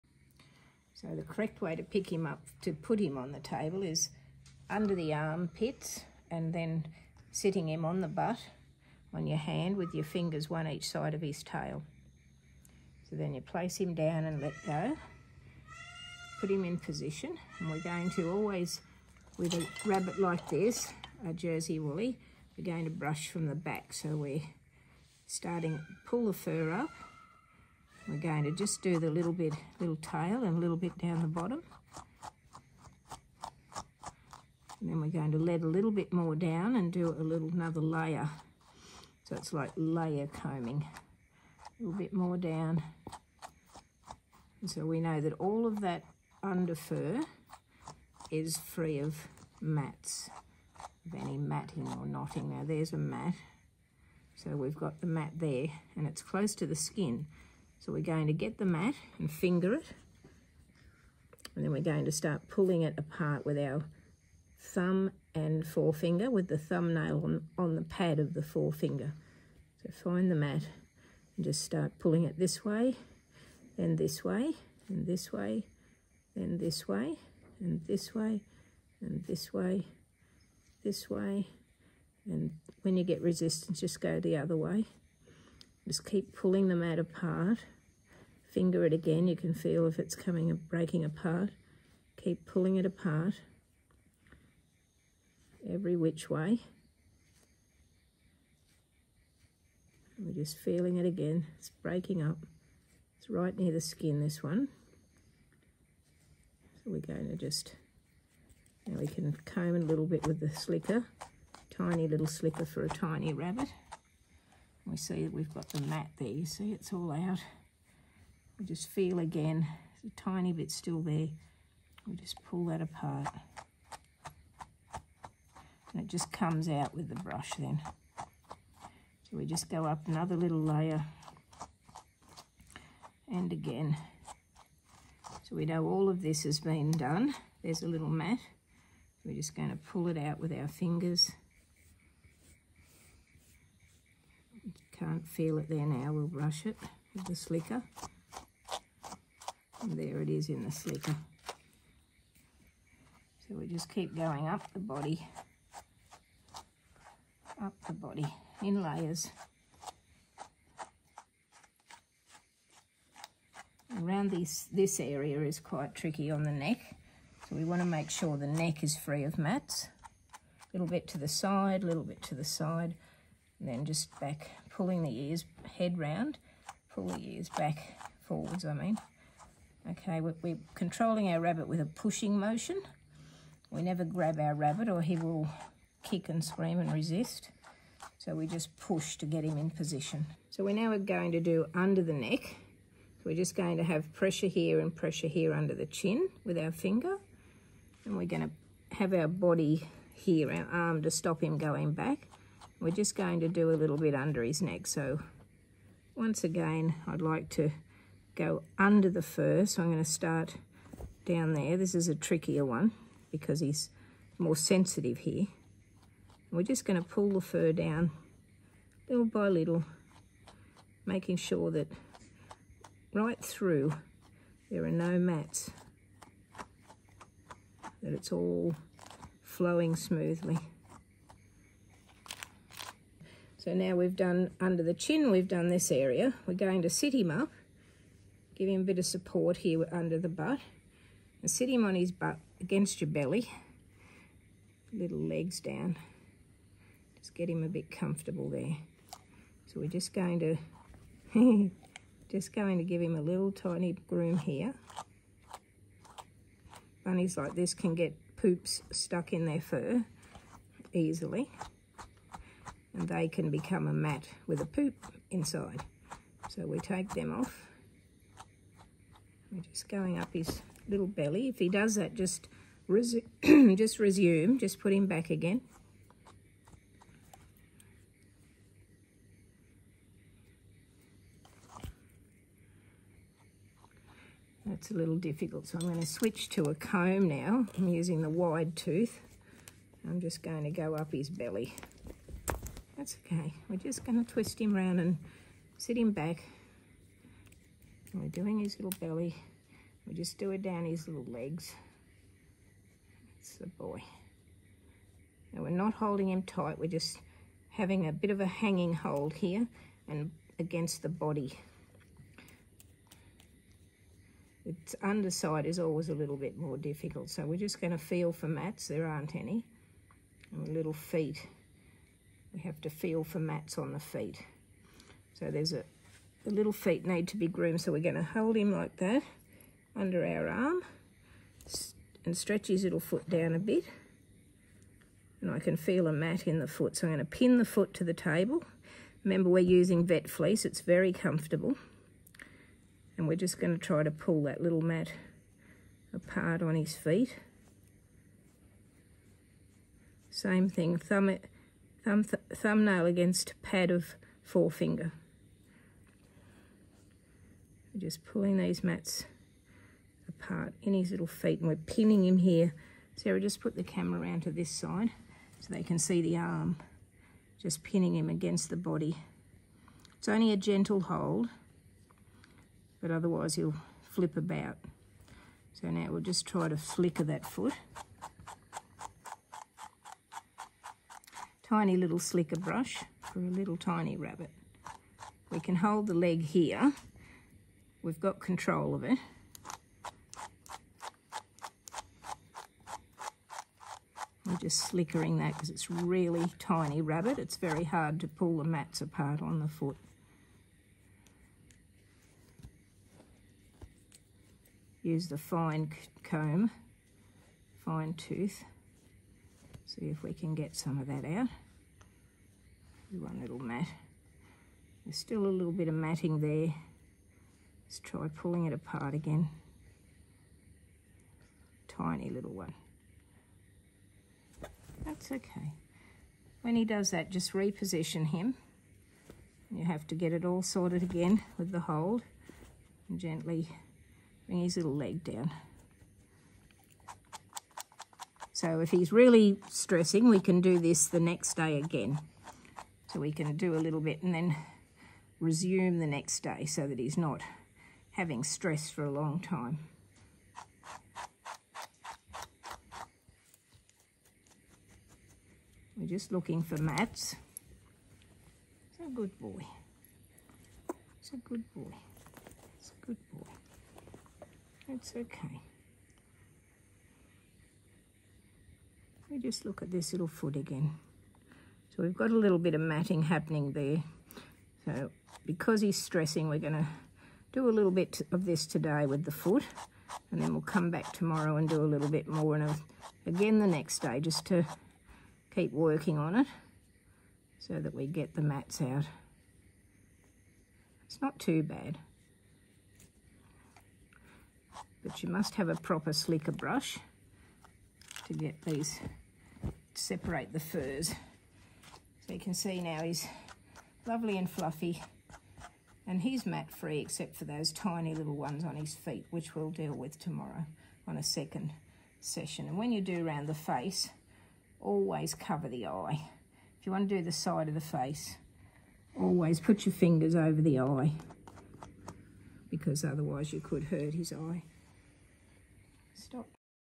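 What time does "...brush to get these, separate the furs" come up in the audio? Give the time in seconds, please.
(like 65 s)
496 s.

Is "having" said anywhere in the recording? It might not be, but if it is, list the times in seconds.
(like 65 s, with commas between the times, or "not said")
307 s, 448 s.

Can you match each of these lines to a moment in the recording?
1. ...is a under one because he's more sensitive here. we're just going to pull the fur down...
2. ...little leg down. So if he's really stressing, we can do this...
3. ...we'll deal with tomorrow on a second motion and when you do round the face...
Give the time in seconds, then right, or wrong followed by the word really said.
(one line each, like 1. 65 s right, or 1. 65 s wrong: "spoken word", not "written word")
1. 211 s wrong: "trickier", not "under"
2. 434 s right
3. 509 s wrong: "session", not "motion".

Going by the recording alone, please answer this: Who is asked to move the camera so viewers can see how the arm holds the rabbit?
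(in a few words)
Sarah.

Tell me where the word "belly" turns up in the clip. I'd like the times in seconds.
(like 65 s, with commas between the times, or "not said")
243 s, 271 s, 291 s, 298 s.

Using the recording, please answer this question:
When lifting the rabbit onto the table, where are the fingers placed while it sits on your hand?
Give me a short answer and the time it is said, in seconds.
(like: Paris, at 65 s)
One each side of his tail, at 10 s.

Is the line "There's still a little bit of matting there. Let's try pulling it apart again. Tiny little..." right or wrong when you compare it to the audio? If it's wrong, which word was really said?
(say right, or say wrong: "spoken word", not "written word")
right.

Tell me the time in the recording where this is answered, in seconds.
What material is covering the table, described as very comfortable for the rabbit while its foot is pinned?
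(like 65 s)
340 s.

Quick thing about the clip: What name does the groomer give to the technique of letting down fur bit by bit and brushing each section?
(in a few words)
Layer combing.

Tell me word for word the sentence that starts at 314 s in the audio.
Its underside is always a little bit more difficult.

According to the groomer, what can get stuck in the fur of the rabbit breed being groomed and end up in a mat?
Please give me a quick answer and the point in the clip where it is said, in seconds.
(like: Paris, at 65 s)
Poops, at 258 s.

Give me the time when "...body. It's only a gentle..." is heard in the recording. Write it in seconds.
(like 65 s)
368 s.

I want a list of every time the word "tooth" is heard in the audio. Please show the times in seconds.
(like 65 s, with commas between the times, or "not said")
288 s, 408 s.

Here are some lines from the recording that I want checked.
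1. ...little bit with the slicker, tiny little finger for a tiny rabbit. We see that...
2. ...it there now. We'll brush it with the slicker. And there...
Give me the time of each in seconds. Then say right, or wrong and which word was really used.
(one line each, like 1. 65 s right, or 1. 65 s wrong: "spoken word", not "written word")
1. 109 s wrong: "slicker", not "finger"
2. 145 s right.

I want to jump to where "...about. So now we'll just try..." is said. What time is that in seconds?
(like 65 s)
374 s.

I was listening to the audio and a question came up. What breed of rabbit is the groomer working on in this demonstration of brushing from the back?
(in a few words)
Jersey Wooly.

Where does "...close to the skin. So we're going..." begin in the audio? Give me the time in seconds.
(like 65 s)
56 s.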